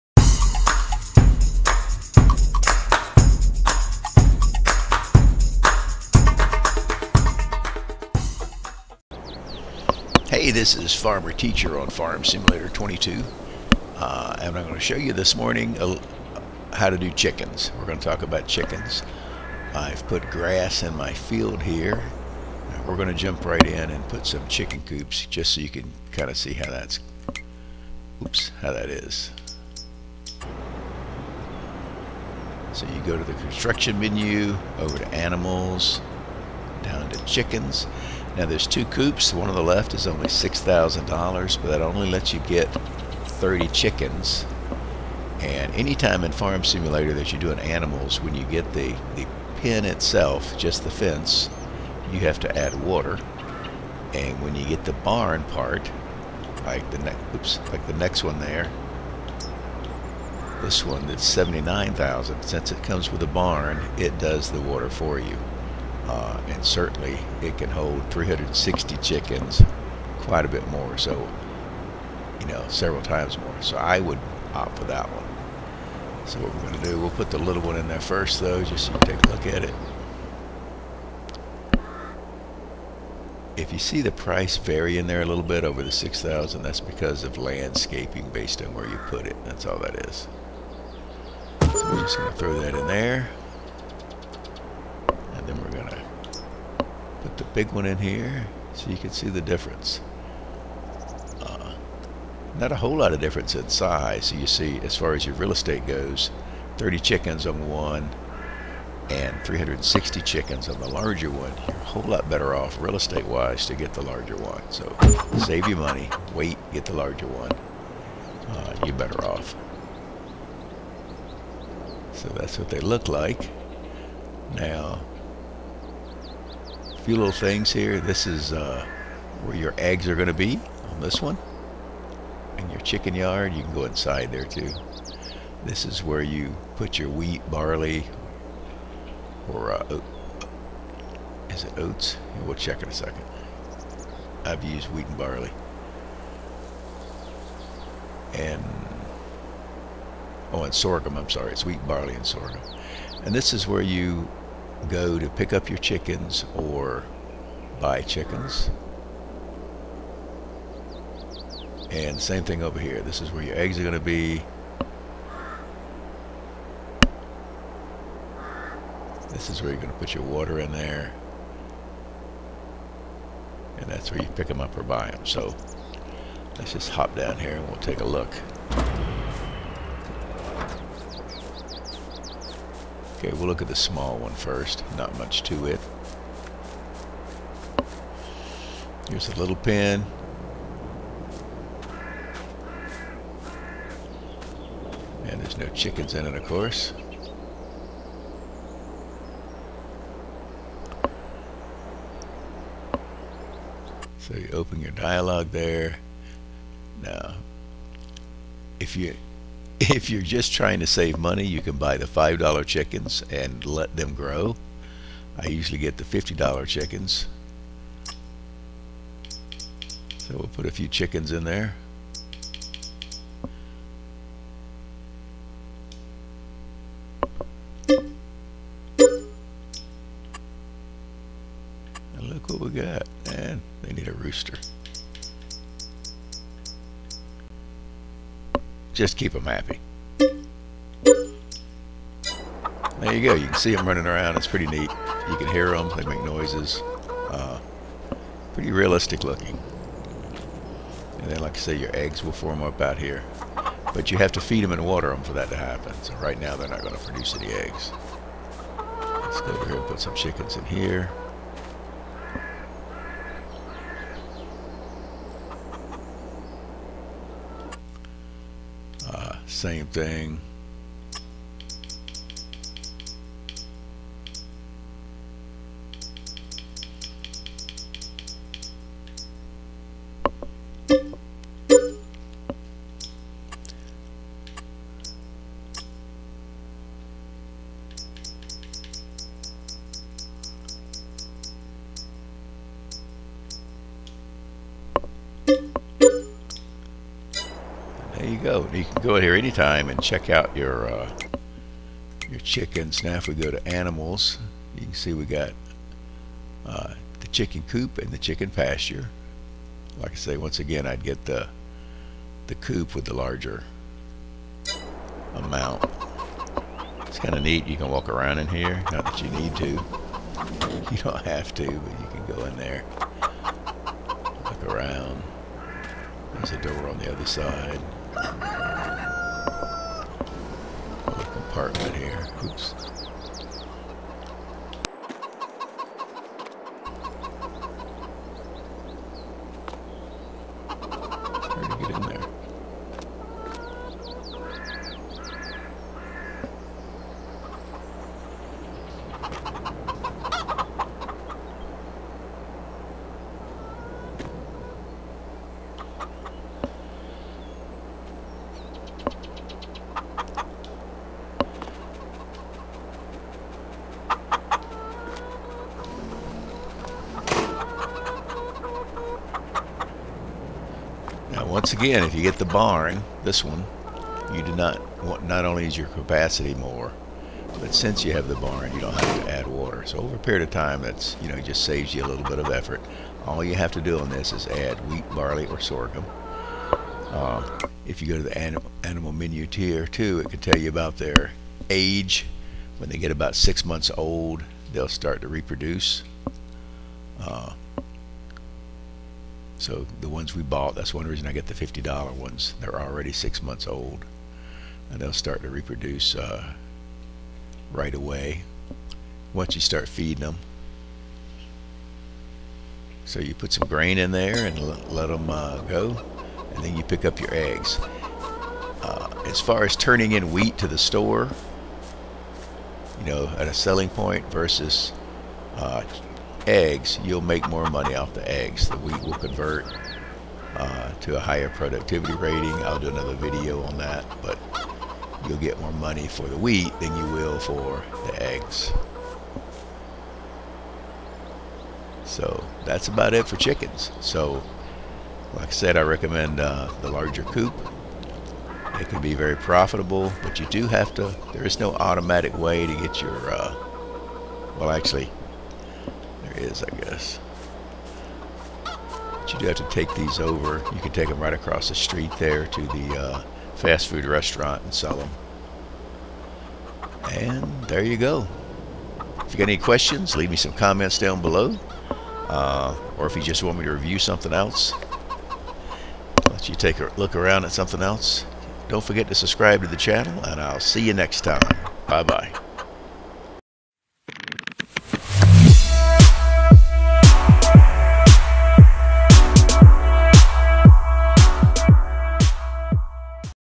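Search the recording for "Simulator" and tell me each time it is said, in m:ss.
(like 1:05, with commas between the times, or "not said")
0:12, 0:46.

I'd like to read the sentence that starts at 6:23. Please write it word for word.
All you have to do on this is add wheat, barley, or sorghum.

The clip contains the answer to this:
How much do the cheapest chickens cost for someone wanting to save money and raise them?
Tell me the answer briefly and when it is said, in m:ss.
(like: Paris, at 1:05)
$5, at 3:32.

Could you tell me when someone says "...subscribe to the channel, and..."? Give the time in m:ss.
7:59.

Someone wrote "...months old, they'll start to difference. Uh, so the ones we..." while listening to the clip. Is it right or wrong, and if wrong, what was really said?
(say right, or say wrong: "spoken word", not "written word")
wrong: "reproduce", not "difference".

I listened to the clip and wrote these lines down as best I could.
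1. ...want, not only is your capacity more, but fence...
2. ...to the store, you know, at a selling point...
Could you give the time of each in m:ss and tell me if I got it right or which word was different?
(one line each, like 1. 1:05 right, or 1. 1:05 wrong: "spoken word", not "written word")
1. 6:15 wrong: "since", not "fence"
2. 7:00 right.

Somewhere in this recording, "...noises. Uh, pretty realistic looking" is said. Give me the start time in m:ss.
4:06.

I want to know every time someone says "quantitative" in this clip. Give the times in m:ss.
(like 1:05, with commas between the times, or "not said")
not said.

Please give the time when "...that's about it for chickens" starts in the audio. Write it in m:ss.
7:22.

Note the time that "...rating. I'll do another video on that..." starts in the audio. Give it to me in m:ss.
7:12.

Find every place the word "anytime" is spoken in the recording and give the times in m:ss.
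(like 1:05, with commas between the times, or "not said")
0:45, 4:59.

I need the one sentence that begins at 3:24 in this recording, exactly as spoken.
So you open your dialog there.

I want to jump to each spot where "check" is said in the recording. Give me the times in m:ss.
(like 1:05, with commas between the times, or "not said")
2:22, 5:00.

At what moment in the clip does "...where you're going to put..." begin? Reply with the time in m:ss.
2:49.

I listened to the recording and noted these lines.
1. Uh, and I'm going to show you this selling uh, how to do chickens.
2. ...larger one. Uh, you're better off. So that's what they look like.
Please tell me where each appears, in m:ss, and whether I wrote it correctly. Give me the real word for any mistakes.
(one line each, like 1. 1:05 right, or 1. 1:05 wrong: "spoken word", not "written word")
1. 0:13 wrong: "morning", not "selling"
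2. 1:56 right.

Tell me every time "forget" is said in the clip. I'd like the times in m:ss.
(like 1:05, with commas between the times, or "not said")
7:58.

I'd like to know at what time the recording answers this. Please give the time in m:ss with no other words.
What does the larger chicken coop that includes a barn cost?
1:01.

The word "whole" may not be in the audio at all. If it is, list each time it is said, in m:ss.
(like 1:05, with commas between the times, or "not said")
1:42, 1:51.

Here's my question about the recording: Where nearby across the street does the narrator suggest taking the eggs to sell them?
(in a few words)
fast food restaurant.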